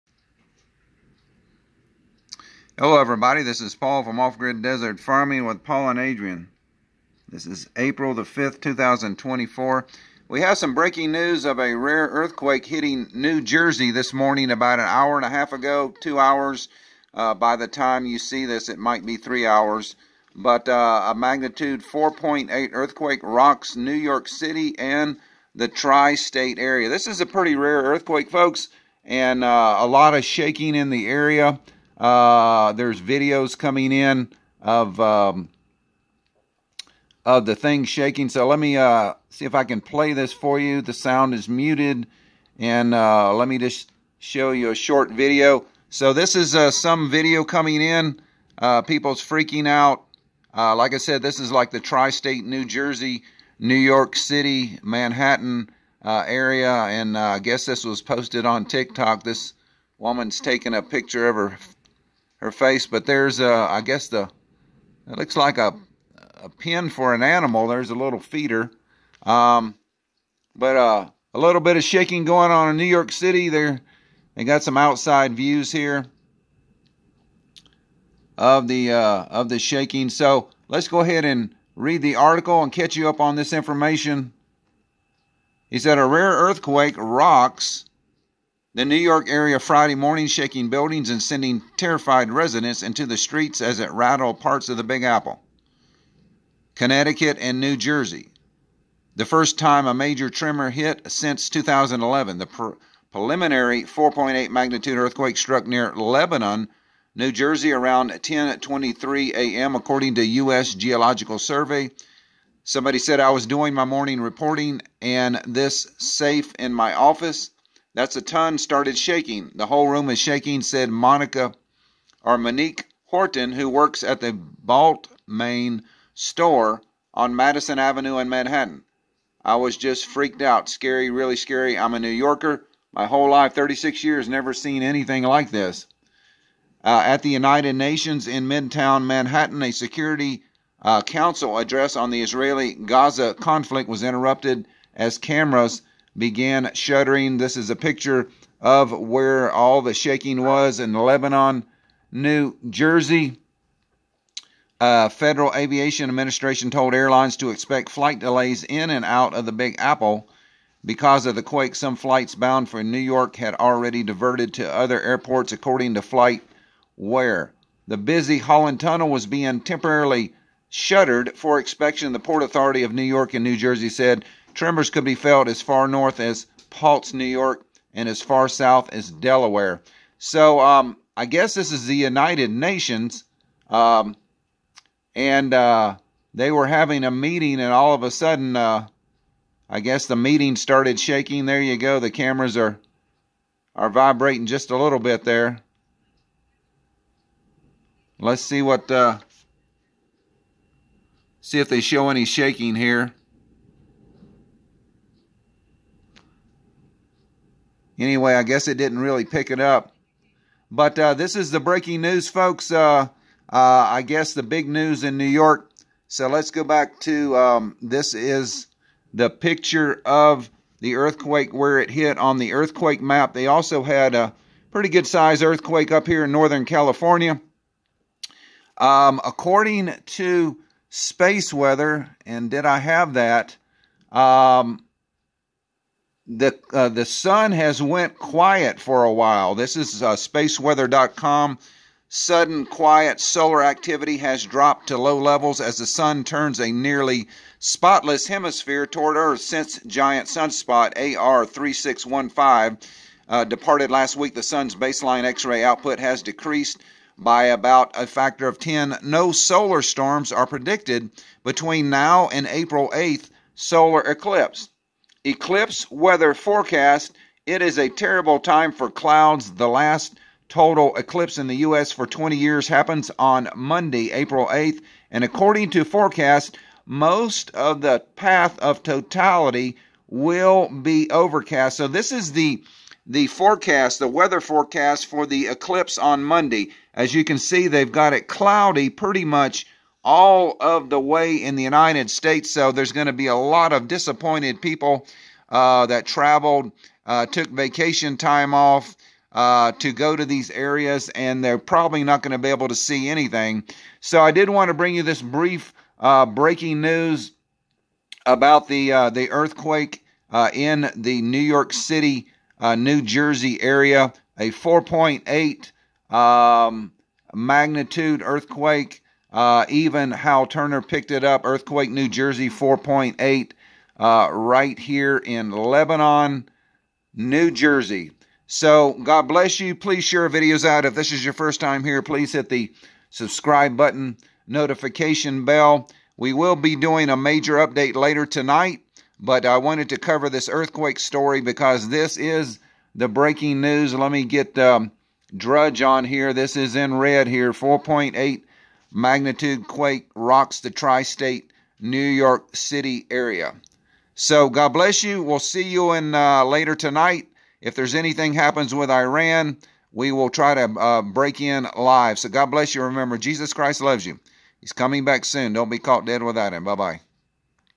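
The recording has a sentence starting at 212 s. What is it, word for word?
Uh, uh, I guess the big news in New York.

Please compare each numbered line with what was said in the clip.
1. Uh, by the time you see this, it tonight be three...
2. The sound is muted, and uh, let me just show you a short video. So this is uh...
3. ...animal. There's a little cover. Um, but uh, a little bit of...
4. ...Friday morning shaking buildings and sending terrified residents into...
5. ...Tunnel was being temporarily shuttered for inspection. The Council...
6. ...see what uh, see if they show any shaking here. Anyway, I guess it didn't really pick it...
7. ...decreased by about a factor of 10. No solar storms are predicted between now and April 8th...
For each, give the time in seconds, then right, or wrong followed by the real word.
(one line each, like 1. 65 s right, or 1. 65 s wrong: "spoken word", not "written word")
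1. 17 s wrong: "might", not "tonight"
2. 40 s right
3. 67 s wrong: "feeder", not "cover"
4. 89 s right
5. 168 s wrong: "Port", not "Council"
6. 198 s right
7. 256 s right.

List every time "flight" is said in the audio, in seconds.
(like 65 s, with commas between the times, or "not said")
157 s, 161 s, 166 s.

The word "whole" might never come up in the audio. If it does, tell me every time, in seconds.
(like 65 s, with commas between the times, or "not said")
119 s, 133 s.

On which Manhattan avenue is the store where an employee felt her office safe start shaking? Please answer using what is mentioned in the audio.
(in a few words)
Madison Avenue.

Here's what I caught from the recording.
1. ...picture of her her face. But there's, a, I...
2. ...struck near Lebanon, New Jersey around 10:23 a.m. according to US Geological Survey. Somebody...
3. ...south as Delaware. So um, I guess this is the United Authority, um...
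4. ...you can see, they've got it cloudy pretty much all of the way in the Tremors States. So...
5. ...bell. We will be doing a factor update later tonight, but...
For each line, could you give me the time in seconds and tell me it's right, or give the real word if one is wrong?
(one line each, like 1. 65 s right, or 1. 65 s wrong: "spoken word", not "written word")
1. 60 s right
2. 105 s right
3. 178 s wrong: "Nations", not "Authority"
4. 287 s wrong: "United", not "Tremors"
5. 335 s wrong: "major", not "factor".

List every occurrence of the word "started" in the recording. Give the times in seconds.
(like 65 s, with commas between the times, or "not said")
118 s, 190 s.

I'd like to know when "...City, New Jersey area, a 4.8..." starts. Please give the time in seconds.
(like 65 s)
311 s.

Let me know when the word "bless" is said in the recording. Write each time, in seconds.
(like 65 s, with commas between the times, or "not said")
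329 s, 354 s, 362 s.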